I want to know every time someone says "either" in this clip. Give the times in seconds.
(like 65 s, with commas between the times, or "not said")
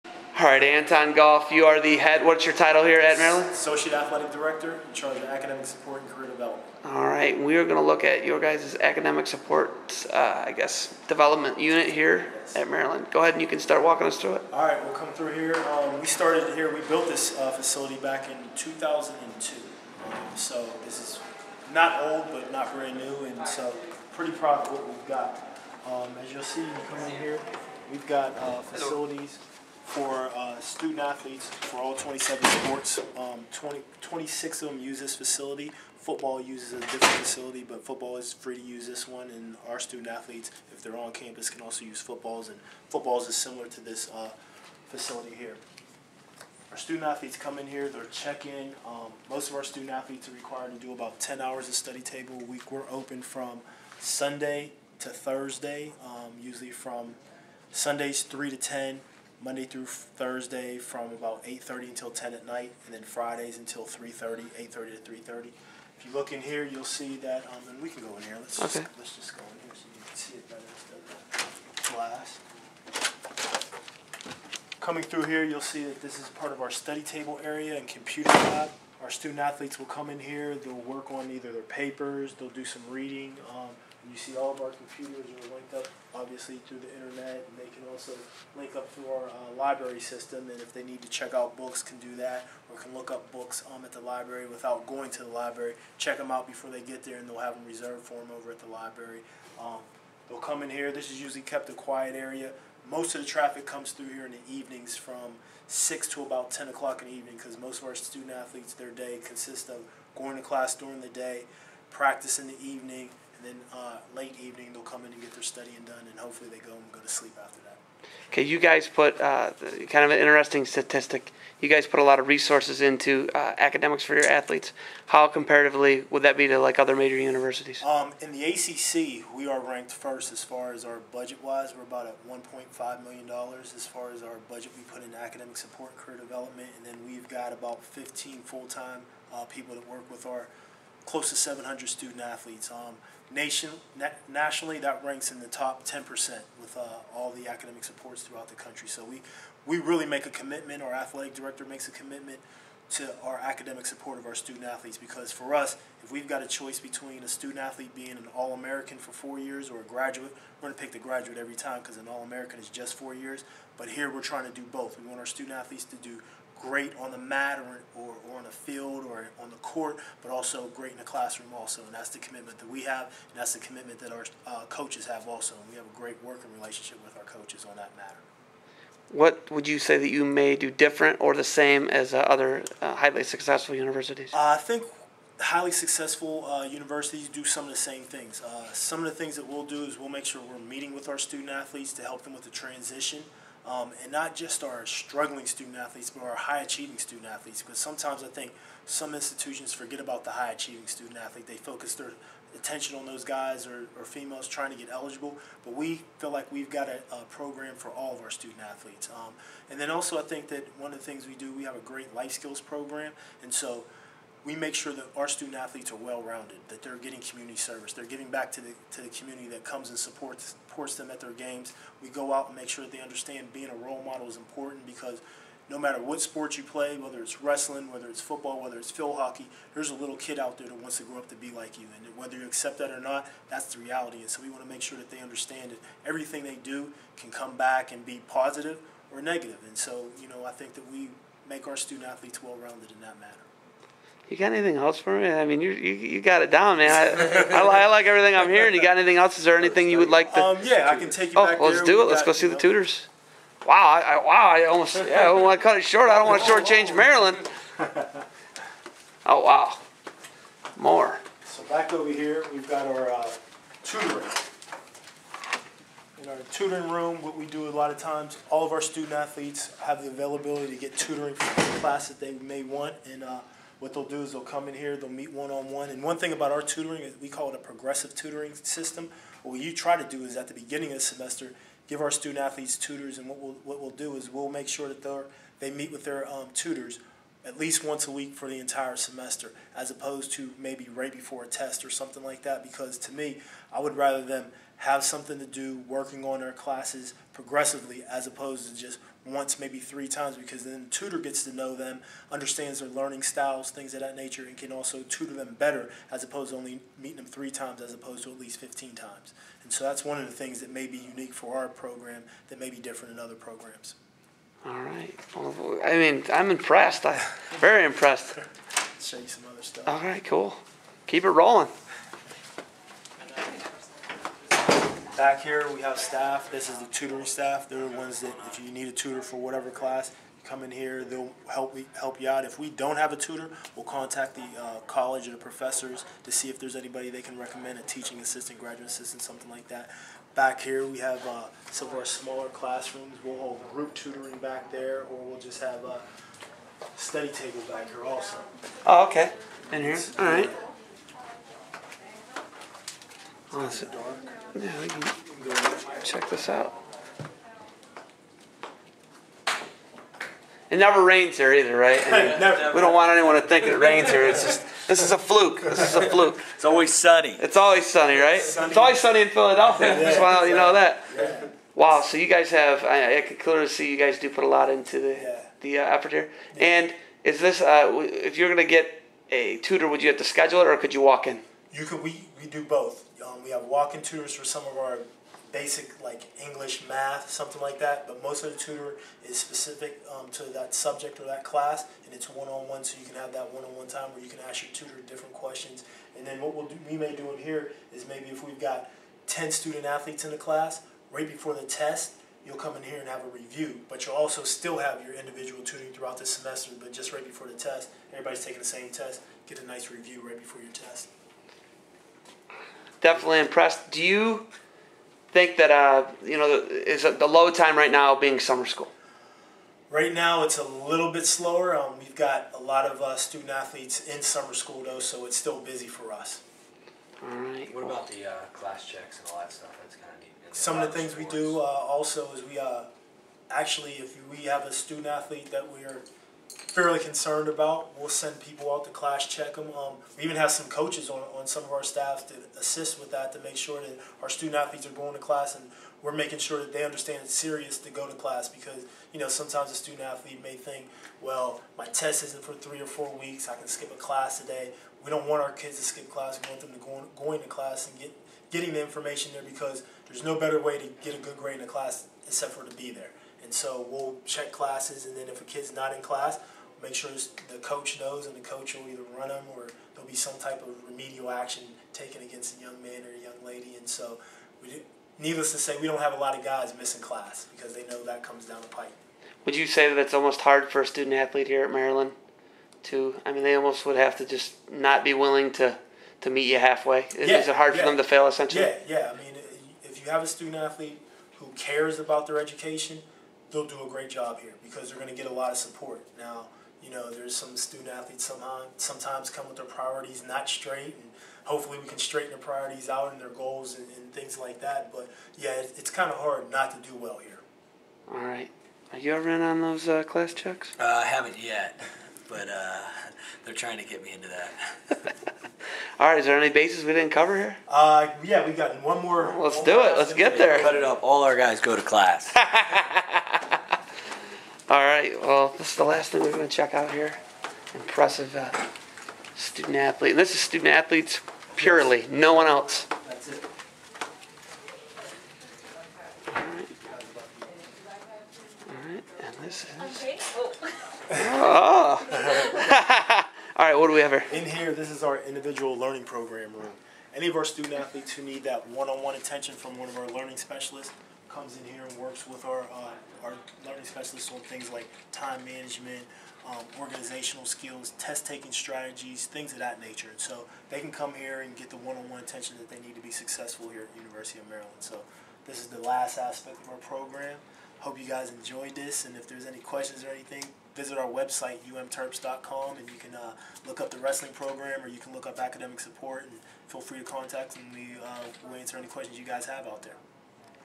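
81 s, 361 s, 468 s.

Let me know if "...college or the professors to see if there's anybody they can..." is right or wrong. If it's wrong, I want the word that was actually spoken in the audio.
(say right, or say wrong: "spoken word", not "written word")
right.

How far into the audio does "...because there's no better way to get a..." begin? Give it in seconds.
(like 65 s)
459 s.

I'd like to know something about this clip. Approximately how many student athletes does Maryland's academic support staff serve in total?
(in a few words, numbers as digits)
700.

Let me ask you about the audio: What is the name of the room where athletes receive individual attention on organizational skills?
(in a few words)
individual learning program room.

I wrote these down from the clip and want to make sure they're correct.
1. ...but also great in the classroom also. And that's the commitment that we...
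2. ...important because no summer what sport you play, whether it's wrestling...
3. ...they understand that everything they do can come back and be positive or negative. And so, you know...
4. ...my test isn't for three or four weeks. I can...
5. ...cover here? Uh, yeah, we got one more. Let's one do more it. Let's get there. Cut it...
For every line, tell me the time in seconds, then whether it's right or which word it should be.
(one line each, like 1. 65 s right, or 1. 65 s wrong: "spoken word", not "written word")
1. 170 s right
2. 224 s wrong: "matter", not "summer"
3. 235 s right
4. 451 s right
5. 517 s right.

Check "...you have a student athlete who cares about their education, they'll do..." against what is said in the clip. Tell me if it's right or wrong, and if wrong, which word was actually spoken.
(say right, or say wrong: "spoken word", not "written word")
right.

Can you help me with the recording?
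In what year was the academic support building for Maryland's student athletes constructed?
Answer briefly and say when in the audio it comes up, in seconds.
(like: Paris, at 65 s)
2002, at 18 s.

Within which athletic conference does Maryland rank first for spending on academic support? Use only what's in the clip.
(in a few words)
ACC.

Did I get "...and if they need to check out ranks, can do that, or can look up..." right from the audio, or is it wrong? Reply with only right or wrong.
wrong.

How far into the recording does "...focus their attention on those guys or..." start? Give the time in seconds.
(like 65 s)
201 s.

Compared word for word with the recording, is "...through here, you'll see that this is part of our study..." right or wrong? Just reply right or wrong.
right.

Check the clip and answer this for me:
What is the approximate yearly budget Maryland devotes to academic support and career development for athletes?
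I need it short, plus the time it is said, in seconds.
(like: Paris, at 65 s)
$1.5 million, at 132 s.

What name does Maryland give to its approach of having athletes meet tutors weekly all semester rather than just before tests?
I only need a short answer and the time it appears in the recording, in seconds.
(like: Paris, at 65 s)
progressive tutoring system, at 277 s.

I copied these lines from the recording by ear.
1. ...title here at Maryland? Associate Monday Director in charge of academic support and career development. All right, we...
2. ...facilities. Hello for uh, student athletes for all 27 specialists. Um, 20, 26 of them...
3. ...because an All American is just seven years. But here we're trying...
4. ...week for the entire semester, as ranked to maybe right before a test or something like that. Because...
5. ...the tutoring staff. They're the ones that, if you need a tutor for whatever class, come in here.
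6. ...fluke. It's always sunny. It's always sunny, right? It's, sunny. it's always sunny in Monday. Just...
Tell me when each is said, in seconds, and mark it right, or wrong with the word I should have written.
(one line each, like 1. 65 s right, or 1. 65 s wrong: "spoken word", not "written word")
1. 2 s wrong: "Athletic", not "Monday"
2. 28 s wrong: "sports", not "specialists"
3. 161 s wrong: "four", not "seven"
4. 288 s wrong: "opposed", not "ranked"
5. 326 s right
6. 366 s wrong: "Philadelphia", not "Monday".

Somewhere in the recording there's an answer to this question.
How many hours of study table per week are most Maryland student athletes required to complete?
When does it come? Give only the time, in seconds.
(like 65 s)
51 s.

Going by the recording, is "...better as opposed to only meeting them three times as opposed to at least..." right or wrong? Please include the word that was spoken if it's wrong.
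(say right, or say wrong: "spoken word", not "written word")
right.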